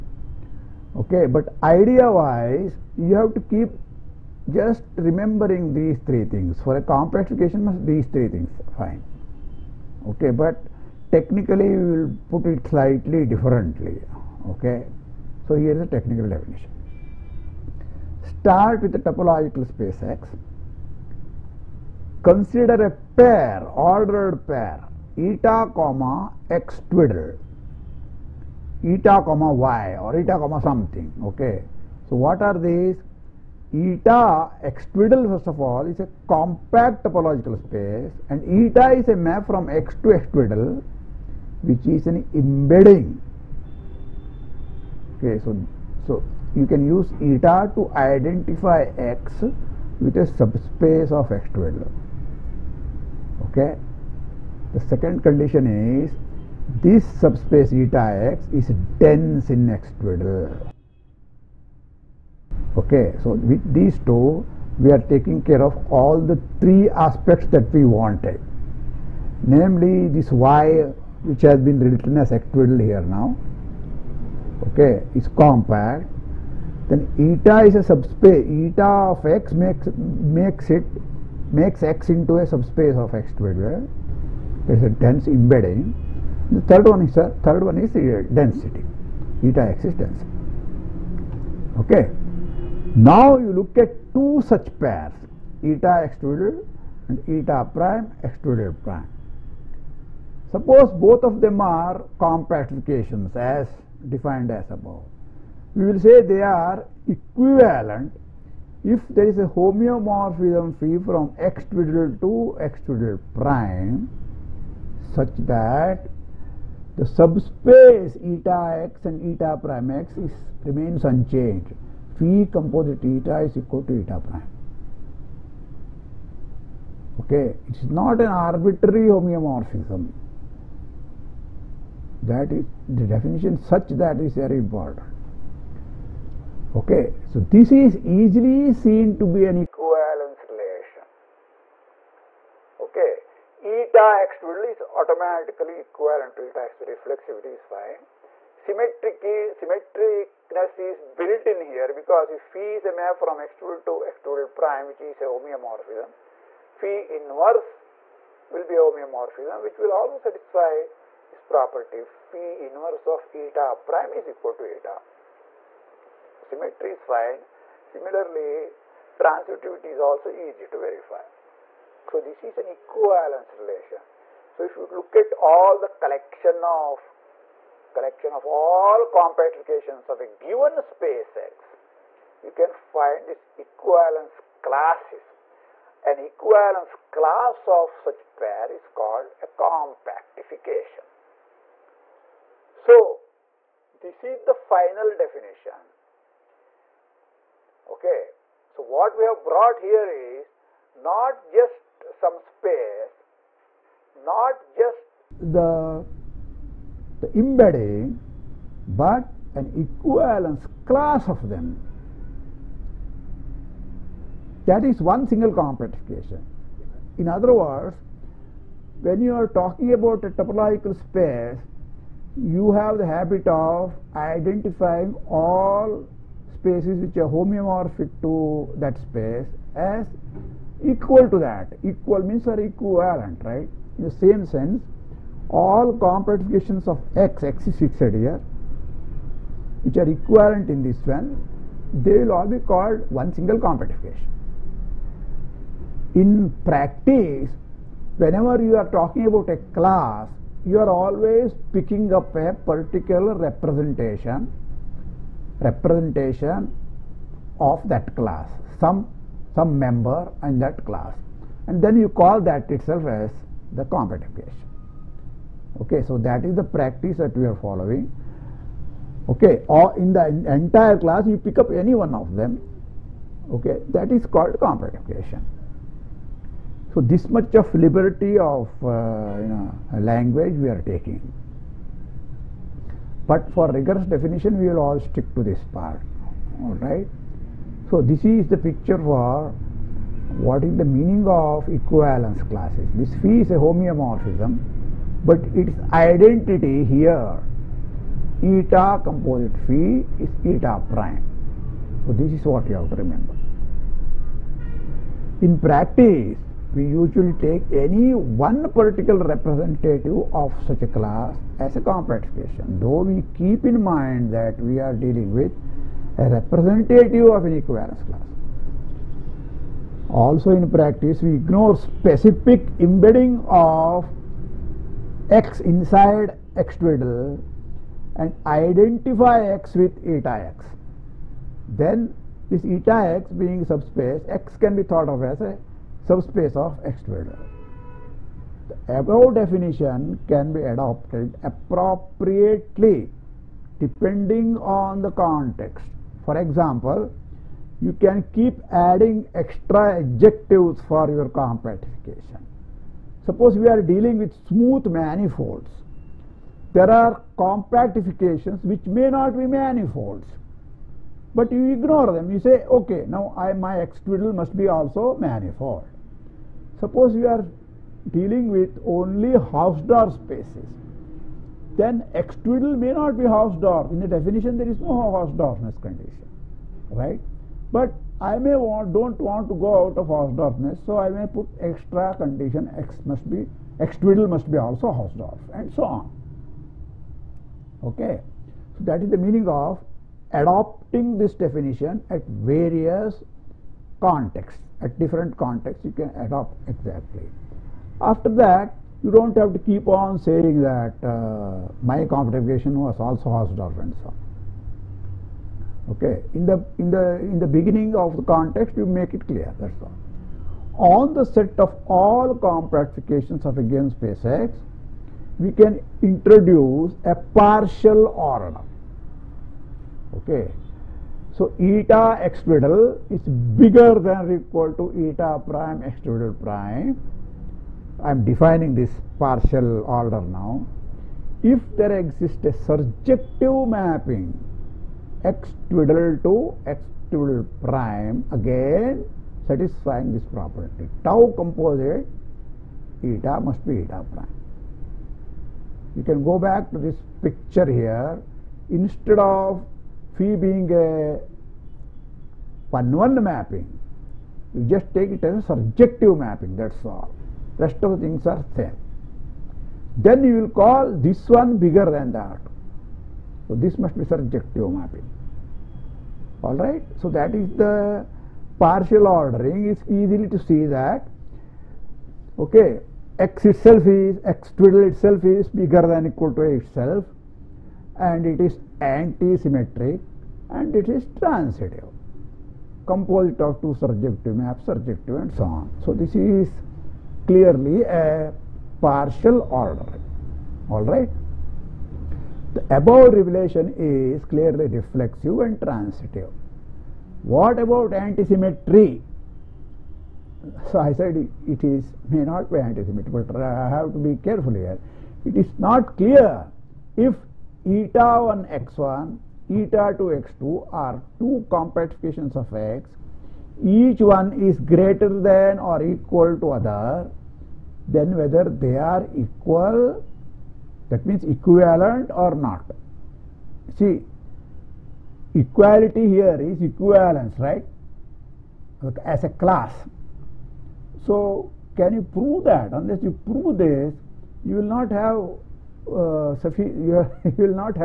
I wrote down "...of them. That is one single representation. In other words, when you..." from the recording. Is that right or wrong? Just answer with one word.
wrong.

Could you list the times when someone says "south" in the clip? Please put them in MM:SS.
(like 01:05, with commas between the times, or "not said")
not said.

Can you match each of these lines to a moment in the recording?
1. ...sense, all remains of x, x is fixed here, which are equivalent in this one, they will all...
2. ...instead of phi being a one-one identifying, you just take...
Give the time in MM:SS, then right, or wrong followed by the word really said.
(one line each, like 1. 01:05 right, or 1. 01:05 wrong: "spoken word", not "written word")
1. 03:54 wrong: "compactifications", not "remains"
2. 07:28 wrong: "mapping", not "identifying".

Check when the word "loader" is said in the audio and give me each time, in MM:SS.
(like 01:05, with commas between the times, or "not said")
not said.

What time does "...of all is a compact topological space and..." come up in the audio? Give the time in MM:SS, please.
00:35.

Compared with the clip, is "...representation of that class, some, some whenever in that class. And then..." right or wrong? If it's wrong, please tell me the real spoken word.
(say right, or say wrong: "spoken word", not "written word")
wrong: "member", not "whenever".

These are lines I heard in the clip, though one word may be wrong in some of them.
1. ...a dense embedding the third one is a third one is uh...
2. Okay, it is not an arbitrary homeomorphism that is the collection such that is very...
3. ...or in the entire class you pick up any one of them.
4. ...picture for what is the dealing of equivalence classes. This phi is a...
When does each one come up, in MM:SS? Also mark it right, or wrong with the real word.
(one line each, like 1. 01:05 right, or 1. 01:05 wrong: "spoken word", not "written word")
1. 01:24 right
2. 02:07 wrong: "definition", not "collection"
3. 04:29 right
4. 04:48 wrong: "meaning", not "dealing".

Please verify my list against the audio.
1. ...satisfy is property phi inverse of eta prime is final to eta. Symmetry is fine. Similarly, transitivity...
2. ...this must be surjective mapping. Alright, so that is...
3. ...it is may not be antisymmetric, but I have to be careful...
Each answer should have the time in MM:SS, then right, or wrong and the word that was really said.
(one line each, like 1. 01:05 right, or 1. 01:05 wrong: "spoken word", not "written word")
1. 02:40 wrong: "equal", not "final"
2. 07:43 right
3. 08:21 right.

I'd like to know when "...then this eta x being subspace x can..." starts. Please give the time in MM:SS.
05:31.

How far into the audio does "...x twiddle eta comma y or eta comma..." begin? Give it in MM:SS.
00:26.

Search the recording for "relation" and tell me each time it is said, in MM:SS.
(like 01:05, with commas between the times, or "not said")
02:20, 02:53.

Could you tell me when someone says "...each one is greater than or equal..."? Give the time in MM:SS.
08:33.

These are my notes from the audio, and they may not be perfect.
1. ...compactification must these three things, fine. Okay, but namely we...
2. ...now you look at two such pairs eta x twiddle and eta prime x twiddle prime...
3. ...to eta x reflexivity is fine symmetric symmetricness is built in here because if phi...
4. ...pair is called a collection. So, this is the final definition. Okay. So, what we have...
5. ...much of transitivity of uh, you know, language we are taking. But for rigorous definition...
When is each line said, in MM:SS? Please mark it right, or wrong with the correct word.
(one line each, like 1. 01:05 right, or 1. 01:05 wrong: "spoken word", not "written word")
1. 00:06 wrong: "technically", not "namely"
2. 01:32 right
3. 02:26 right
4. 03:08 wrong: "compactification", not "collection"
5. 04:37 wrong: "liberty", not "transitivity".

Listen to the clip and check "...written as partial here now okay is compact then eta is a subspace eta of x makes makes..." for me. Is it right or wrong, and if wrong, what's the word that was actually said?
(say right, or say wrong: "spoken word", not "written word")
wrong: "octadal", not "partial".